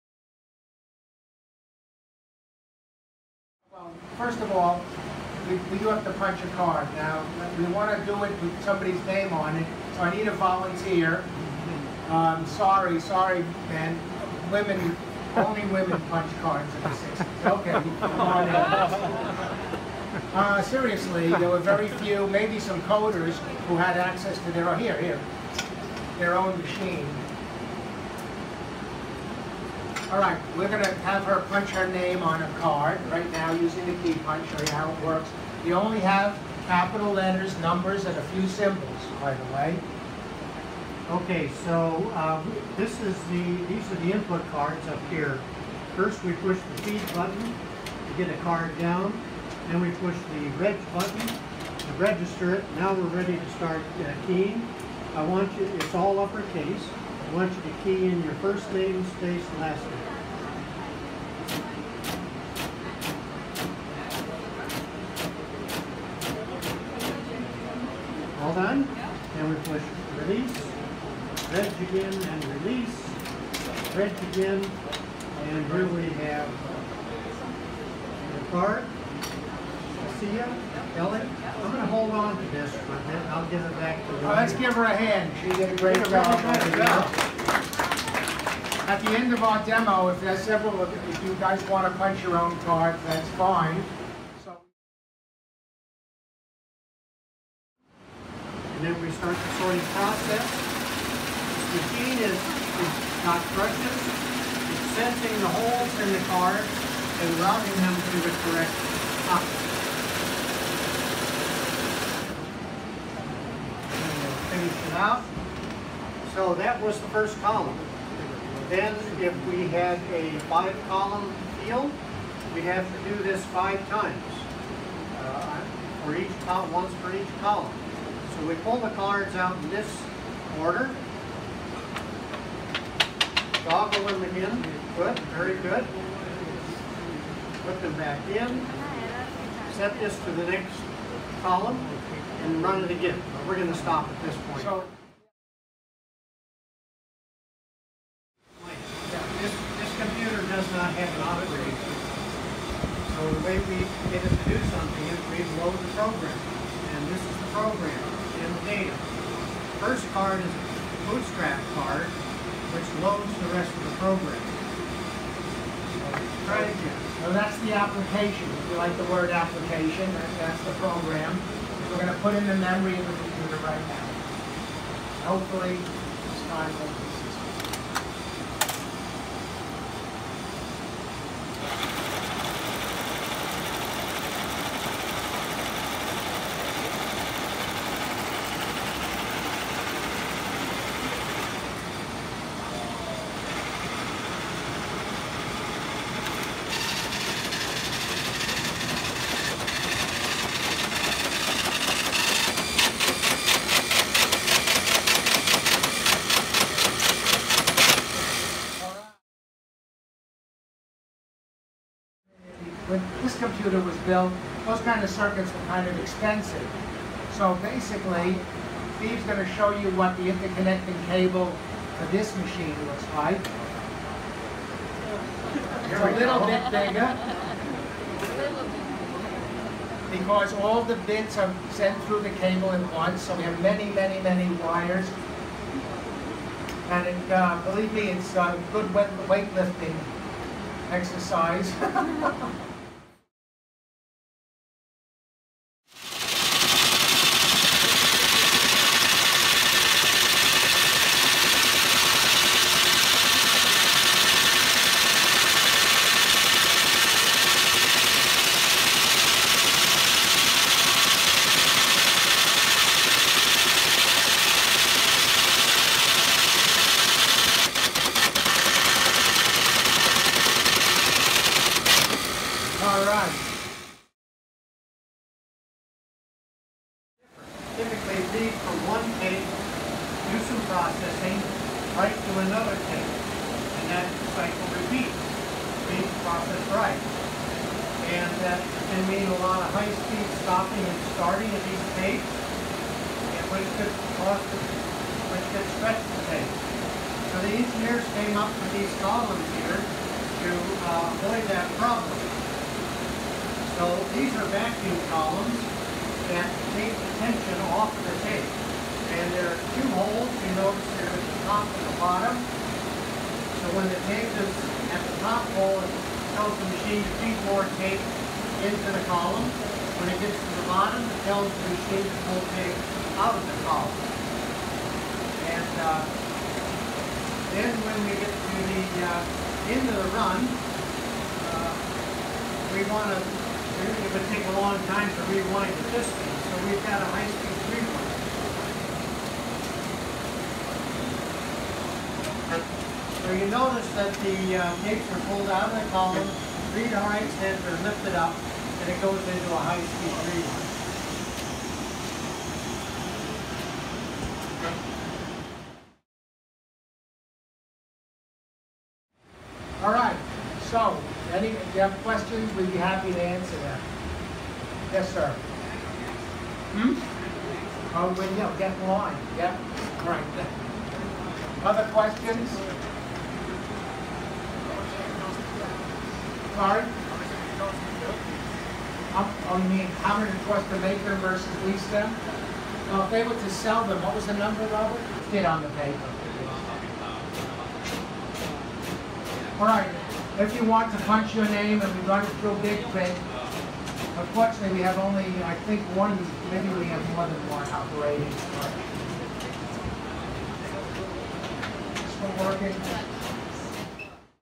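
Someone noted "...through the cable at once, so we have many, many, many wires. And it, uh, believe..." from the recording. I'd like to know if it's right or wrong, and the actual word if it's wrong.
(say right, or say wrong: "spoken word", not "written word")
right.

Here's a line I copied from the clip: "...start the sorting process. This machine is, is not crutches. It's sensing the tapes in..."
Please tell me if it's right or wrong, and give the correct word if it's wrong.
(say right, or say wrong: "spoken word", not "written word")
wrong: "holes", not "tapes".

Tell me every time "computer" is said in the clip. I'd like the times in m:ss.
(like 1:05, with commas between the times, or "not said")
2:29, 2:53.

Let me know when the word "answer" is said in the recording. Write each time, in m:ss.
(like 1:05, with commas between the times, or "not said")
6:03.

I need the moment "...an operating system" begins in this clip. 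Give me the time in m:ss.
2:31.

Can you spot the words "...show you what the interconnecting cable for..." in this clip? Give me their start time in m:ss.
3:39.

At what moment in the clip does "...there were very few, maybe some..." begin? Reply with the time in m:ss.
0:21.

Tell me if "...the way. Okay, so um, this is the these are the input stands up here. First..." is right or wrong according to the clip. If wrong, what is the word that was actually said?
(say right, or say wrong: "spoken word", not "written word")
wrong: "cards", not "stands".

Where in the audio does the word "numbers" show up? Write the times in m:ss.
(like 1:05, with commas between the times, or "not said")
0:37, 6:24.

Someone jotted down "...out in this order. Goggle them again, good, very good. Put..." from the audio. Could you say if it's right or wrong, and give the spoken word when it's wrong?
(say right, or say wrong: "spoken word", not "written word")
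right.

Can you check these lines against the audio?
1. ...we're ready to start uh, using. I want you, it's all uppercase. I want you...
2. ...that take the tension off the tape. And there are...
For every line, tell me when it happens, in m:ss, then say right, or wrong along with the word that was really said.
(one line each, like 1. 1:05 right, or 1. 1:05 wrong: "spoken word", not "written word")
1. 0:52 wrong: "keying", not "using"
2. 5:06 right.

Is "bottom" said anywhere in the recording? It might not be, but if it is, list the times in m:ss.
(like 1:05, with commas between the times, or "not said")
5:11, 5:20.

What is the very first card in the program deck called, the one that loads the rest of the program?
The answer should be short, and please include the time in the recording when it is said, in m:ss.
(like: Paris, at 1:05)
bootstrap card, at 2:41.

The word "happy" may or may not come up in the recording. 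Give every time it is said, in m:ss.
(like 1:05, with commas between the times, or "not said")
6:02.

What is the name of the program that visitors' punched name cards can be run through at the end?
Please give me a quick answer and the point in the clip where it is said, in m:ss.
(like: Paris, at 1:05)
Big Print, at 6:32.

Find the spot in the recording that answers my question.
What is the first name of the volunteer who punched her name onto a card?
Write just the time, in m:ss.
1:20.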